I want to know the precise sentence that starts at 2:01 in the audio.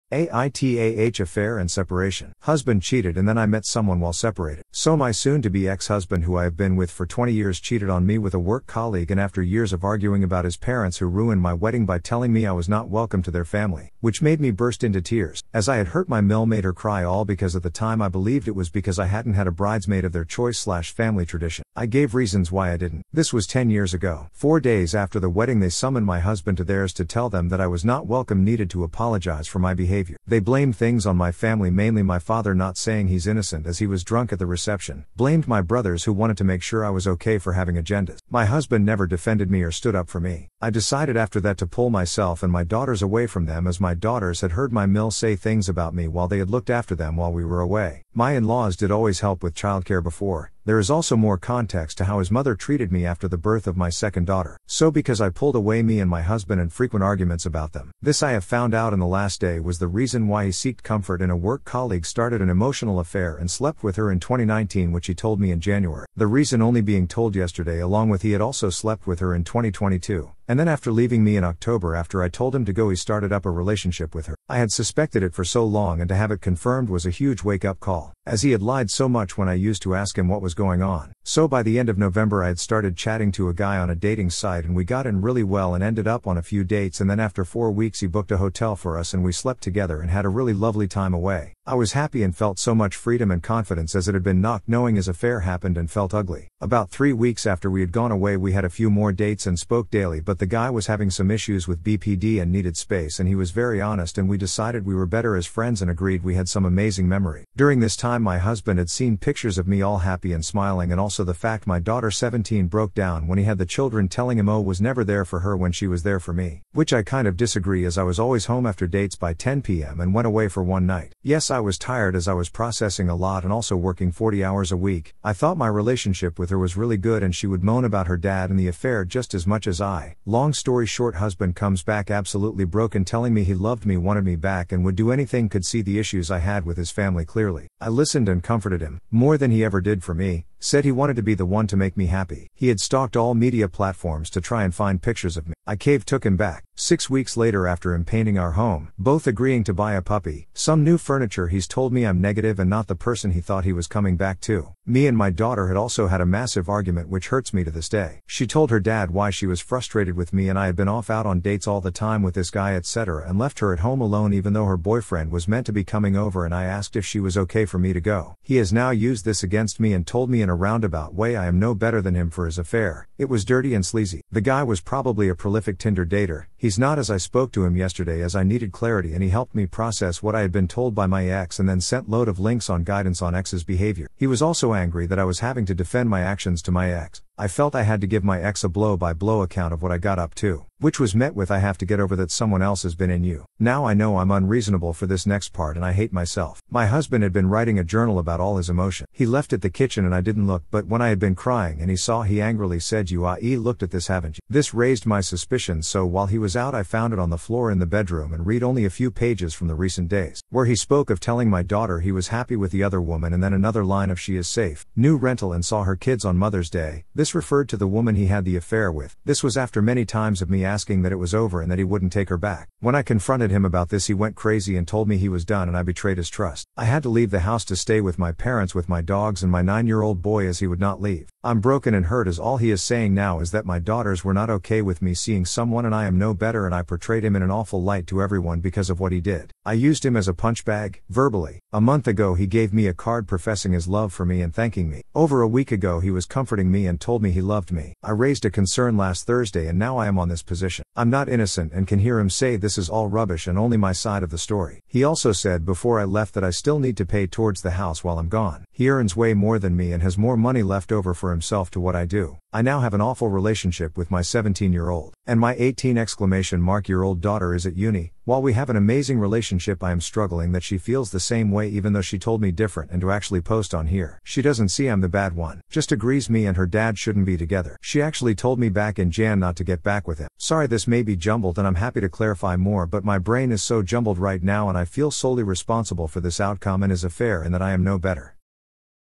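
Yes, I was tired as I was processing a lot and also working 40 hours a week.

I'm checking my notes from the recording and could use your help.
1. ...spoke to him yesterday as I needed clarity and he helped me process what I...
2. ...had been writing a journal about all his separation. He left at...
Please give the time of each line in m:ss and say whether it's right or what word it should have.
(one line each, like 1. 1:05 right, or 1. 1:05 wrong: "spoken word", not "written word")
1. 2:57 right
2. 3:17 wrong: "emotion", not "separation".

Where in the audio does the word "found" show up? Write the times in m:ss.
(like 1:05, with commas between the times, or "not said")
0:58, 3:26.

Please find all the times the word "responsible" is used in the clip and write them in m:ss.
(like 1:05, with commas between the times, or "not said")
4:45.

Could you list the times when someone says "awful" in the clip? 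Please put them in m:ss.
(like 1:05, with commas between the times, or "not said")
3:57, 4:23.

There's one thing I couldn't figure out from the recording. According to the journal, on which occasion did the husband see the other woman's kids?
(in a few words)
Mother's Day.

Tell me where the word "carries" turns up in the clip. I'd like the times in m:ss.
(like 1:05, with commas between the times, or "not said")
not said.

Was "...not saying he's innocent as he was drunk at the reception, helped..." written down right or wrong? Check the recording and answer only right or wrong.
wrong.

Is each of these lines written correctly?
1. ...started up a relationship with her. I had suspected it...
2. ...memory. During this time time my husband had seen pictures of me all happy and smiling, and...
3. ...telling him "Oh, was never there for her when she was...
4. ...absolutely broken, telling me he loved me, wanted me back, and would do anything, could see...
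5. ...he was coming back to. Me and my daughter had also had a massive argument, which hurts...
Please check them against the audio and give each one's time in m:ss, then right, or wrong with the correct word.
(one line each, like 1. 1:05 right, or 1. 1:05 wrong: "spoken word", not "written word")
1. 1:12 right
2. 1:47 right
3. 1:54 right
4. 2:12 right
5. 2:33 right.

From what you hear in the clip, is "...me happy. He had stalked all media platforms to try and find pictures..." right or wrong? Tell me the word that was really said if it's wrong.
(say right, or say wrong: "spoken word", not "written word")
right.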